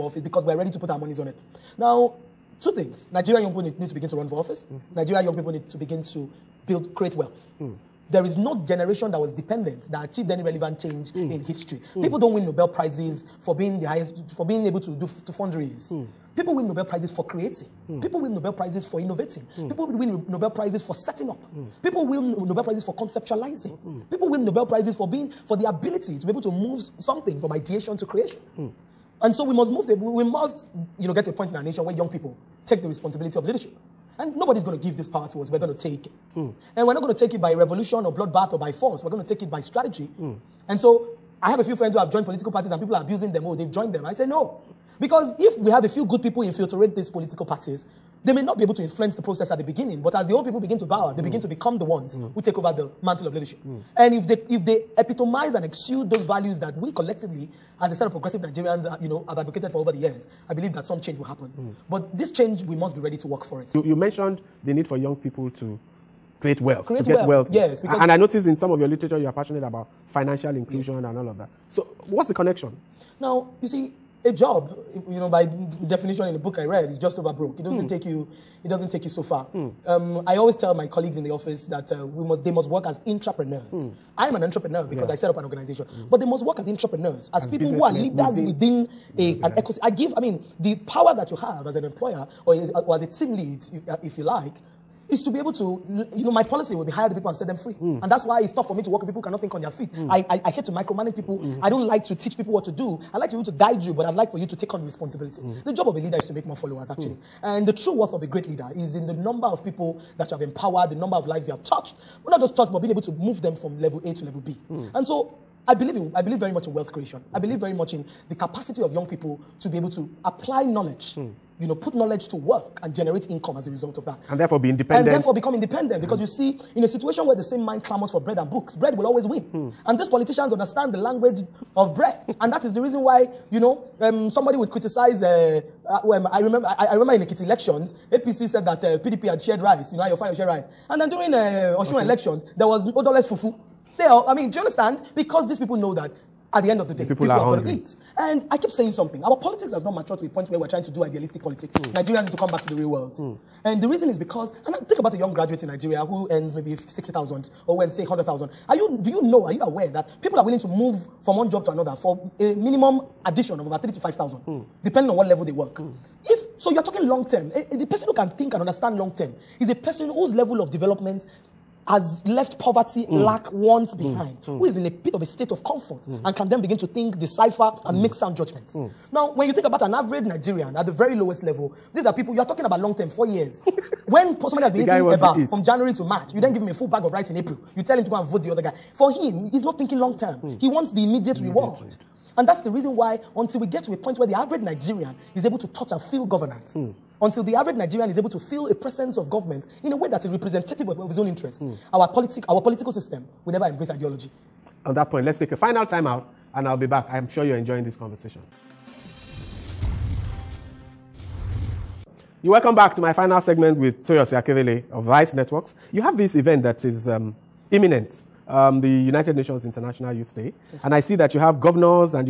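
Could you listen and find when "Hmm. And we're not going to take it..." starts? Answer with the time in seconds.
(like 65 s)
36 s.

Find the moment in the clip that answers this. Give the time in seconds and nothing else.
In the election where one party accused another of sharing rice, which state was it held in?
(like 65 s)
137 s.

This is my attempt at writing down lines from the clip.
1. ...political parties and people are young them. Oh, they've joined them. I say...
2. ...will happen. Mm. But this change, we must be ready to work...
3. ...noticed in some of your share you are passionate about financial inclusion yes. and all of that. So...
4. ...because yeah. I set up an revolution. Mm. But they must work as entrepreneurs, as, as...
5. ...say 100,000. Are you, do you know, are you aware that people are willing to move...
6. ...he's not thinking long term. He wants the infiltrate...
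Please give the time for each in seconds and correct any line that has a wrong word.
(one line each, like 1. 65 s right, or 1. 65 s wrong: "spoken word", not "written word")
1. 42 s wrong: "abusing", not "young"
2. 61 s right
3. 68 s wrong: "literature", not "share"
4. 84 s wrong: "organization", not "revolution"
5. 157 s right
6. 189 s wrong: "immediate", not "infiltrate".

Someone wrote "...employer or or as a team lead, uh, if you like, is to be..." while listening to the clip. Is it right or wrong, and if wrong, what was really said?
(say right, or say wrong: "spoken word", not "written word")
right.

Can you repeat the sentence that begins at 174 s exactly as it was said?
who is in a bit of a state of comfort mm.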